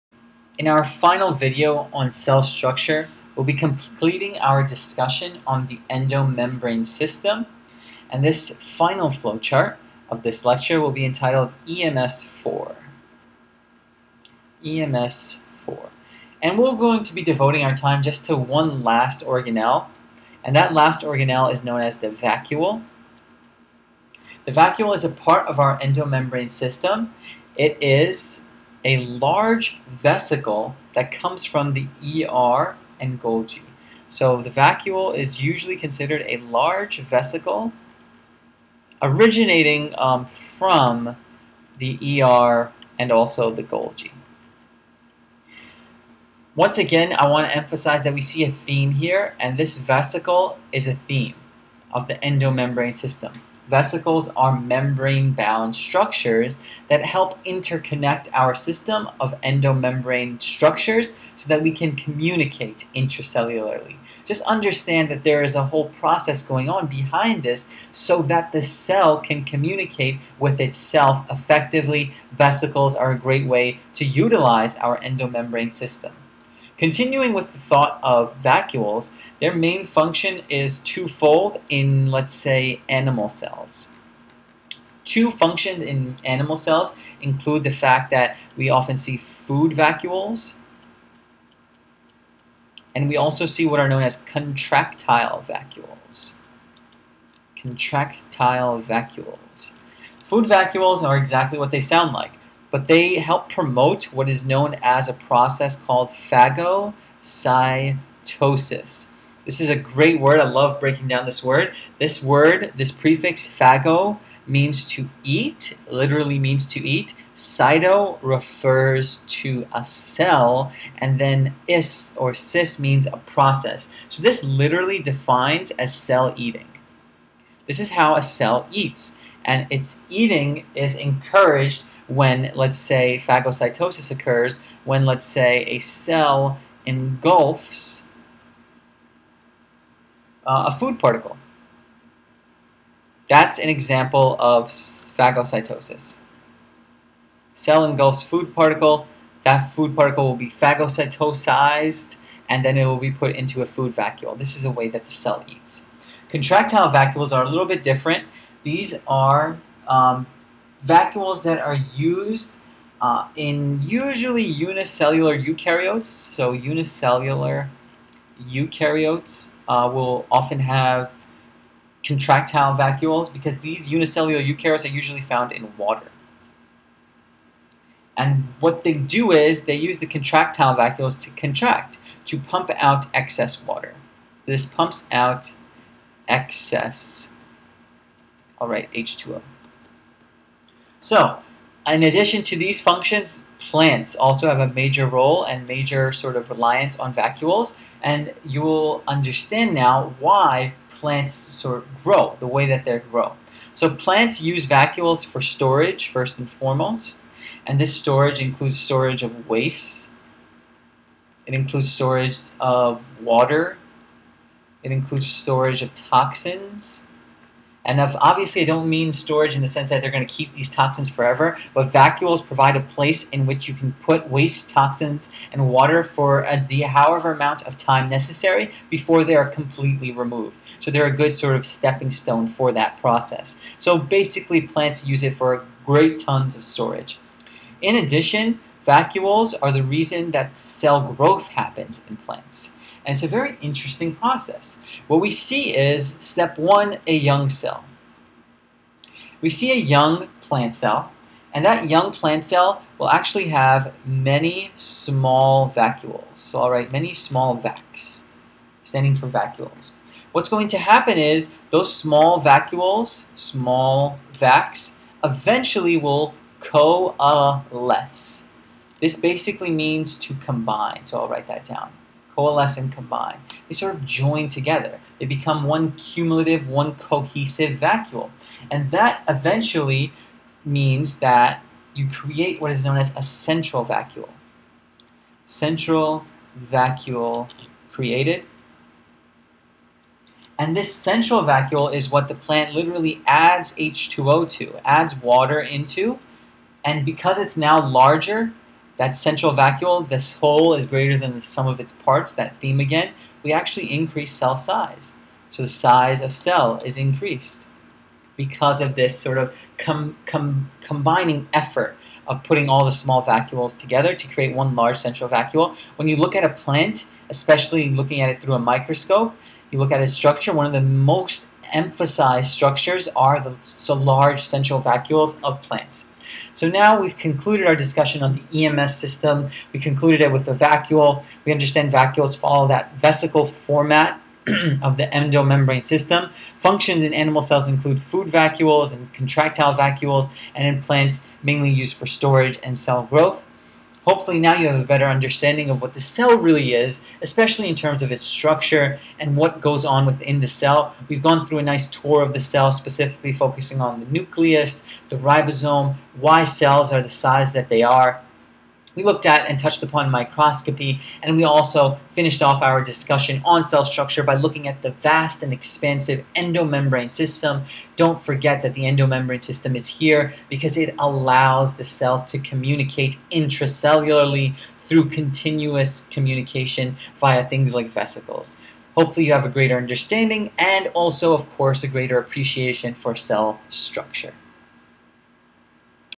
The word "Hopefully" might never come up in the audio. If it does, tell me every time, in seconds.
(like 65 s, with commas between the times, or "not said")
344 s, 378 s.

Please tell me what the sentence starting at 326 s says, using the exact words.
So now we've concluded our discussion on the EMS system.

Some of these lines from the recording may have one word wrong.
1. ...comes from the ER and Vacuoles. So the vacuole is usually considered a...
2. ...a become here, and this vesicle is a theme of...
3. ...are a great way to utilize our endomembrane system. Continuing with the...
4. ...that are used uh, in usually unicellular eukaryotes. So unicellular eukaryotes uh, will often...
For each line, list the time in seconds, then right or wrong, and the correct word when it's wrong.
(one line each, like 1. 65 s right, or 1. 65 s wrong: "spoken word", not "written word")
1. 31 s wrong: "Golgi", not "Vacuoles"
2. 48 s wrong: "theme", not "become"
3. 72 s right
4. 161 s right.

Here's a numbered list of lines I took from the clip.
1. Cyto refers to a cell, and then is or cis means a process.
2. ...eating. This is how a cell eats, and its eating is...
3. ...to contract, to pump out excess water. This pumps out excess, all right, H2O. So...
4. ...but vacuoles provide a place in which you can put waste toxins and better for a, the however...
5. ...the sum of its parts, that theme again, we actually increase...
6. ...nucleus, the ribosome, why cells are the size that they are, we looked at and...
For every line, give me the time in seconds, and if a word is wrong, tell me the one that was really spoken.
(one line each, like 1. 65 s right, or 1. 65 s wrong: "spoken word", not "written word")
1. 117 s right
2. 126 s right
3. 181 s right
4. 221 s wrong: "water", not "better"
5. 301 s right
6. 354 s right.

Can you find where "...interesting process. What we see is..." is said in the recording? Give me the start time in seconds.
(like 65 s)
243 s.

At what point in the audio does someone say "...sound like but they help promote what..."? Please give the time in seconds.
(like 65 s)
101 s.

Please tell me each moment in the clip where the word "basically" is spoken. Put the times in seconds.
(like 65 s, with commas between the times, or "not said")
233 s, 269 s.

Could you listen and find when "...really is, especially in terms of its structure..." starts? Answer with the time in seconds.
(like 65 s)
346 s.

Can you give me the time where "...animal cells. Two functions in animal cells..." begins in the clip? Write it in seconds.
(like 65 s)
82 s.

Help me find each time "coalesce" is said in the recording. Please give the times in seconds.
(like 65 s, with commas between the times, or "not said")
266 s, 272 s.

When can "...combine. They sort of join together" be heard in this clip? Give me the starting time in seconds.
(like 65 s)
272 s.